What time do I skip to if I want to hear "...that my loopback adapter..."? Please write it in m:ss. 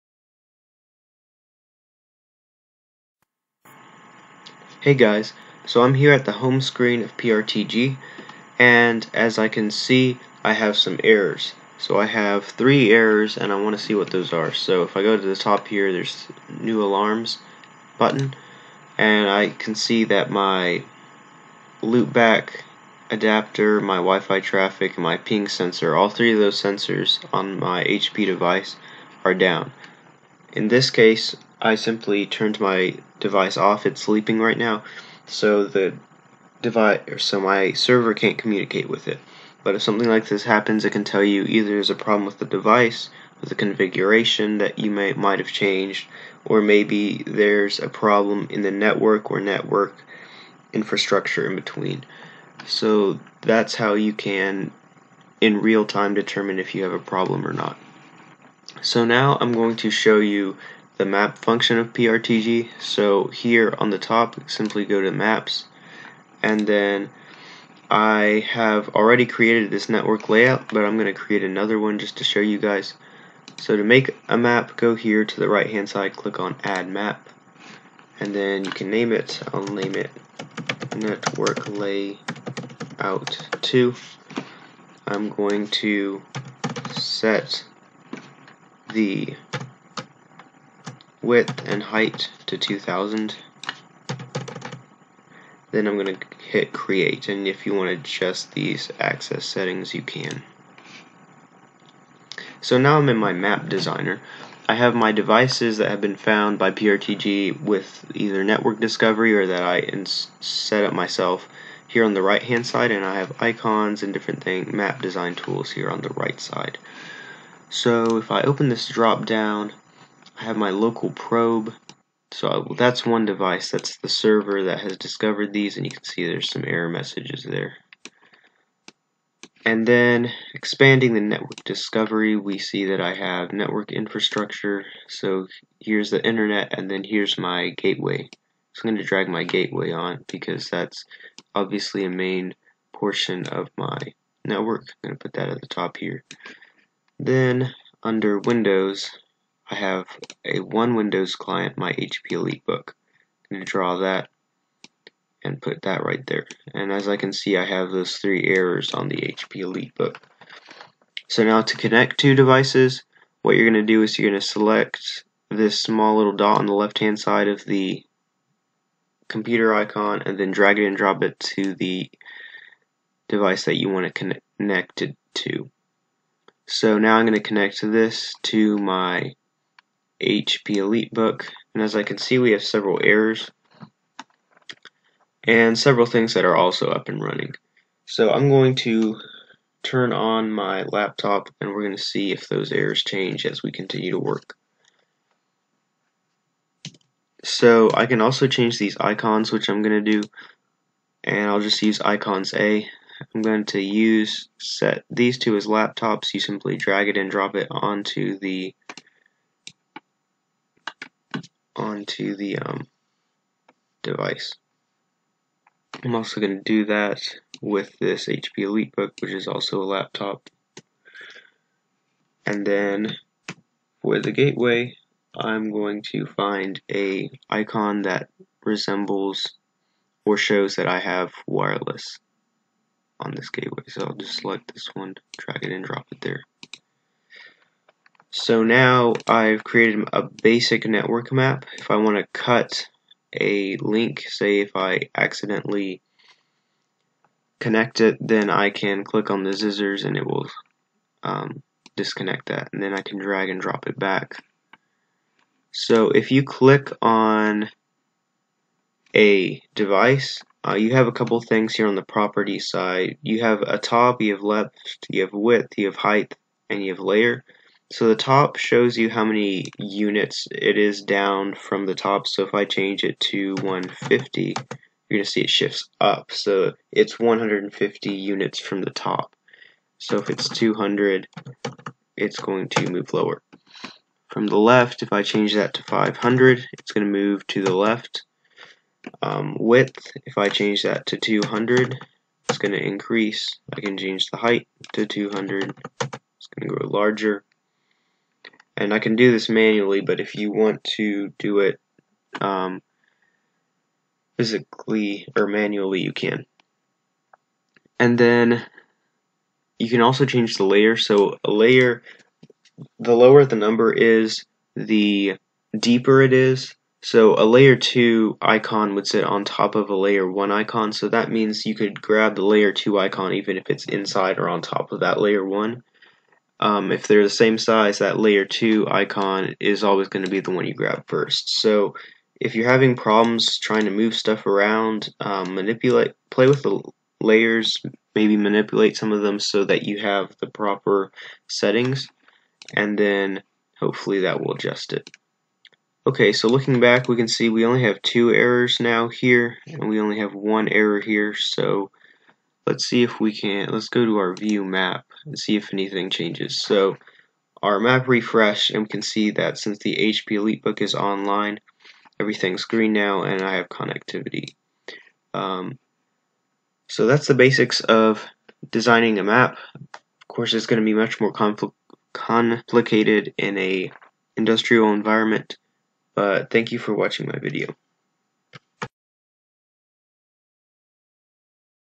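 0:20.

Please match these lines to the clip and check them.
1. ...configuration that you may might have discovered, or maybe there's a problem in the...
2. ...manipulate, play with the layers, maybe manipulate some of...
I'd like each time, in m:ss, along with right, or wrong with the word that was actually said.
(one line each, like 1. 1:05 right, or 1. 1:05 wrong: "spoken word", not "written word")
1. 0:43 wrong: "changed", not "discovered"
2. 5:35 right.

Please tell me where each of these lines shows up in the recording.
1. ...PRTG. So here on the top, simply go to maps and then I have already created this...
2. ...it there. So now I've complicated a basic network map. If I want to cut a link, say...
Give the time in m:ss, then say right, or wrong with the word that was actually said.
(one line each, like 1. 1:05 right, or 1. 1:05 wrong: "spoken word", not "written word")
1. 1:01 right
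2. 3:56 wrong: "created", not "complicated".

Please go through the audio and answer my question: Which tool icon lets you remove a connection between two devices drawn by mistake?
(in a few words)
Scissors.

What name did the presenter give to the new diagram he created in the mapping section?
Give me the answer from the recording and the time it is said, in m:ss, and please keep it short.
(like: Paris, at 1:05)
Network layout 2, at 1:20.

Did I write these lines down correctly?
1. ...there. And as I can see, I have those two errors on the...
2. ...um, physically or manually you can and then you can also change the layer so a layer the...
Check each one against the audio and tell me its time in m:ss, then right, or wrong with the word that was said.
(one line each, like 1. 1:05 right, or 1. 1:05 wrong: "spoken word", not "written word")
1. 2:36 wrong: "three", not "two"
2. 5:02 right.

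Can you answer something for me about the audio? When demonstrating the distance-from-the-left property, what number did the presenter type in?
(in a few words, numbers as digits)
500.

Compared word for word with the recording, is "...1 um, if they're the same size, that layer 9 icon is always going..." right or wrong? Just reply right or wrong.
wrong.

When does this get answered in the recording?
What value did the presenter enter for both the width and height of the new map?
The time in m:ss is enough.
1:32.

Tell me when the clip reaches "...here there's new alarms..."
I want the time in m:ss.
0:15.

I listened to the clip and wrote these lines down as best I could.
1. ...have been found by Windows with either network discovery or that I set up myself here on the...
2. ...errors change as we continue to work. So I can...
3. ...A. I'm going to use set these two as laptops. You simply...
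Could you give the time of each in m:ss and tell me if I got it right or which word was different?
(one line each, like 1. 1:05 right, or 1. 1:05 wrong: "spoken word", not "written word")
1. 1:45 wrong: "PRTG", not "Windows"
2. 3:12 right
3. 3:22 right.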